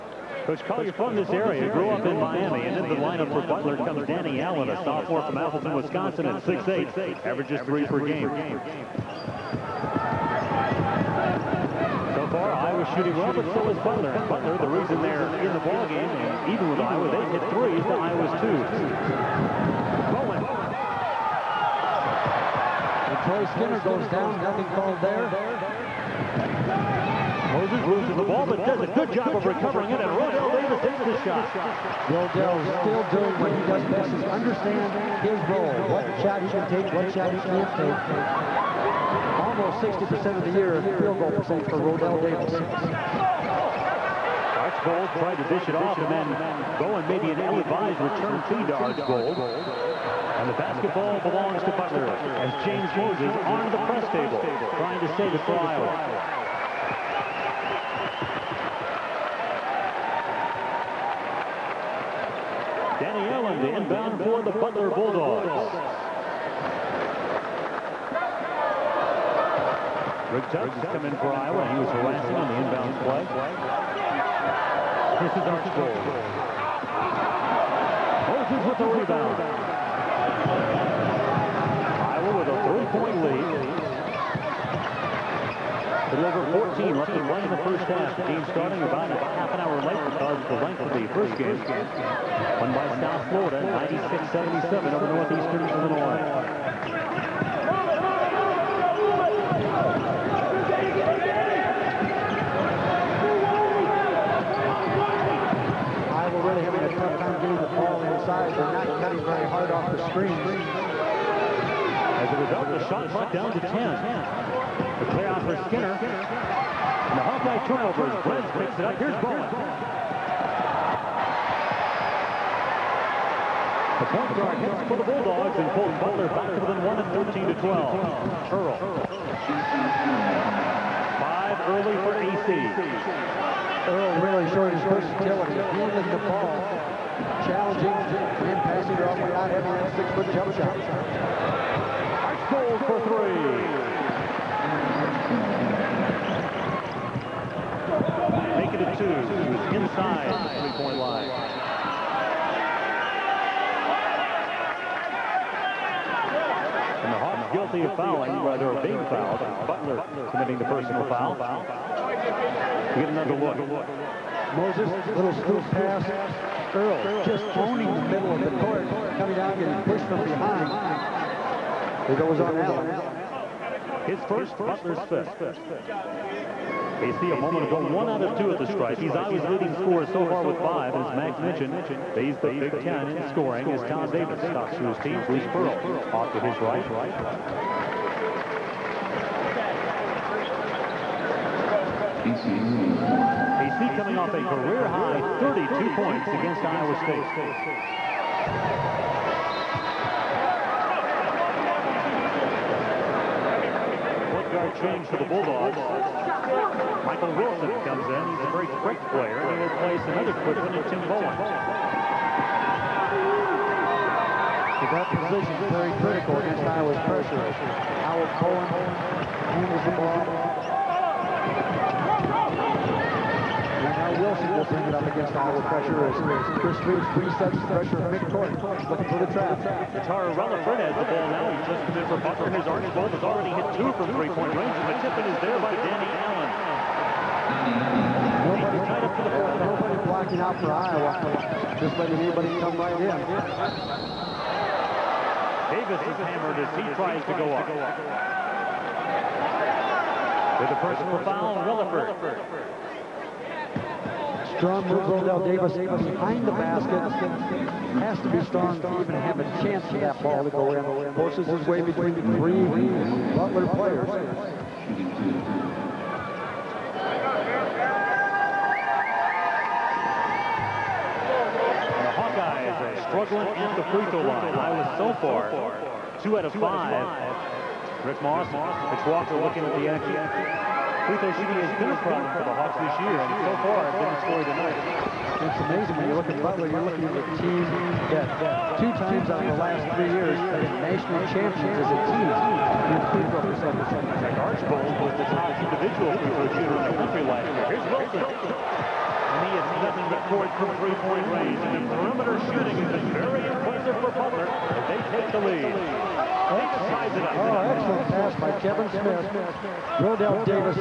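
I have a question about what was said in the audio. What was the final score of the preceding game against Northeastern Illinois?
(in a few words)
96-77.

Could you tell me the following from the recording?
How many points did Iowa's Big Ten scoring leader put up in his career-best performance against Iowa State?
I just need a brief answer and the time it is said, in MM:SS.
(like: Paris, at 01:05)
32, at 03:15.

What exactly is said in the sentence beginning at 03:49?
Katara Reliford has the ball now.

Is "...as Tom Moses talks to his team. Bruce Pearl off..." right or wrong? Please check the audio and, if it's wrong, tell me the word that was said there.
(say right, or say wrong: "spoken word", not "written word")
wrong: "Davis", not "Moses".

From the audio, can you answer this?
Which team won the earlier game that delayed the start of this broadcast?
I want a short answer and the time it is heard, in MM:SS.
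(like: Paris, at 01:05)
South Florida, at 01:32.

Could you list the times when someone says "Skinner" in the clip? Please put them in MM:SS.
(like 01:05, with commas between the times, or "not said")
00:23, 01:55.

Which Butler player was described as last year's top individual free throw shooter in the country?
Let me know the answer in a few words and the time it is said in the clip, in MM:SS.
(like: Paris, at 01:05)
Rick Archbold, at 04:54.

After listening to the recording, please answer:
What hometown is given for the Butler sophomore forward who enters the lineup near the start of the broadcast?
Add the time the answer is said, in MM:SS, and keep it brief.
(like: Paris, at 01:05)
Appleton, Wisconsin, at 00:05.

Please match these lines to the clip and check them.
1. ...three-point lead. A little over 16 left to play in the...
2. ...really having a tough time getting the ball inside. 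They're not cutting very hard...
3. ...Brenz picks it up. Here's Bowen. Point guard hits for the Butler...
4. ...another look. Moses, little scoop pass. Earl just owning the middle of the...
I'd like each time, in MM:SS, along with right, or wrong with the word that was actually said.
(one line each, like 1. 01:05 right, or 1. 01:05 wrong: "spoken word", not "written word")
1. 01:22 wrong: "14", not "16"
2. 01:46 right
3. 01:58 wrong: "Bulldogs", not "Butler"
4. 02:43 right.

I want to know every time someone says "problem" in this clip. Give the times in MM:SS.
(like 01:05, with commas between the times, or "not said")
04:41.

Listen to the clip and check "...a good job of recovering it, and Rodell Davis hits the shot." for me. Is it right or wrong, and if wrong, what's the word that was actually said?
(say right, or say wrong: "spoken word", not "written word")
right.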